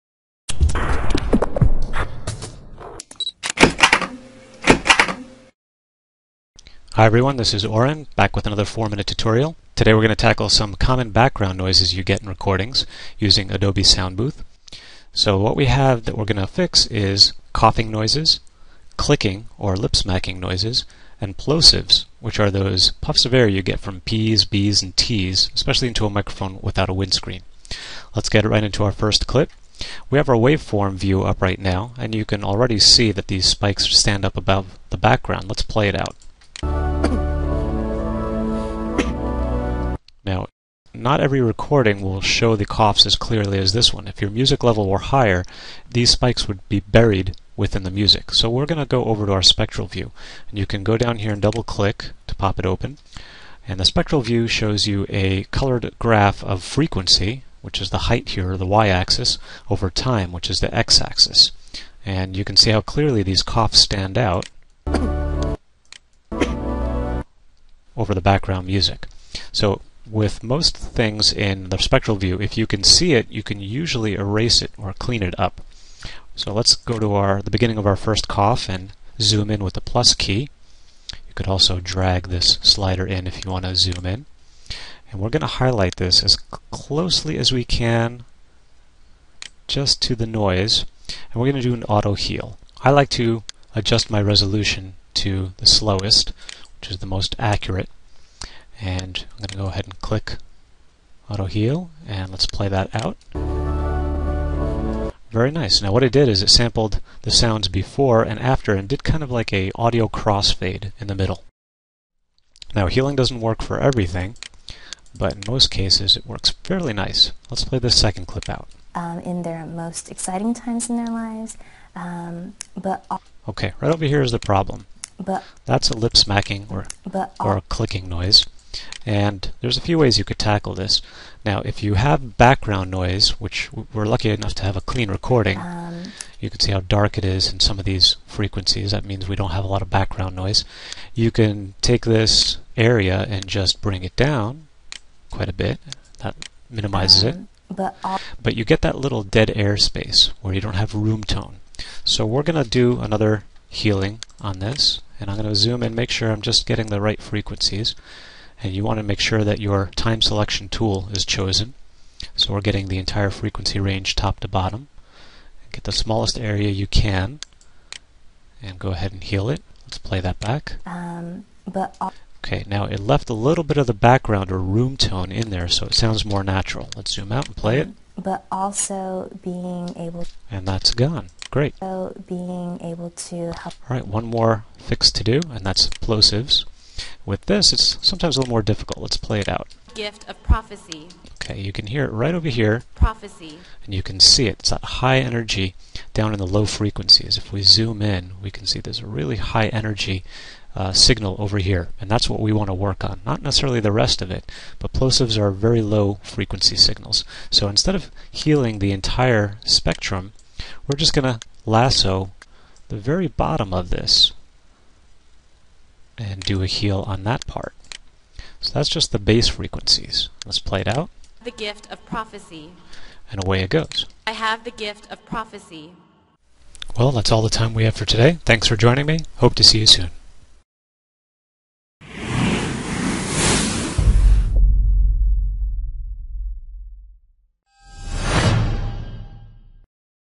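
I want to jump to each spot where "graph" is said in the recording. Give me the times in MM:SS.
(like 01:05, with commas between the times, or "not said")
00:55.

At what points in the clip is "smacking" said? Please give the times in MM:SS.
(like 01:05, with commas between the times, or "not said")
00:19, 02:06.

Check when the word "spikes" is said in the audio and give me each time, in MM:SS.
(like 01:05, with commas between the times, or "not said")
00:33, 00:46.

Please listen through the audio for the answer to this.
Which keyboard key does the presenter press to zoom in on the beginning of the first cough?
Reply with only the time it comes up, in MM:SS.
01:19.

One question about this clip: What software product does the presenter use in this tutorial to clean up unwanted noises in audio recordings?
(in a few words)
Adobe Soundbooth.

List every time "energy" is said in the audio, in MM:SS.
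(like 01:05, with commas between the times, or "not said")
03:15, 03:19.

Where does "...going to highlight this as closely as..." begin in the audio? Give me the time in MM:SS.
01:25.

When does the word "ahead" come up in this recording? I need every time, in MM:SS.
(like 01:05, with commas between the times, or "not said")
01:39, 02:48.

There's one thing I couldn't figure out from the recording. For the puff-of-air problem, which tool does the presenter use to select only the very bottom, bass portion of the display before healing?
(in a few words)
lasso.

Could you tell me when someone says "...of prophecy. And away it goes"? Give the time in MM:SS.
03:41.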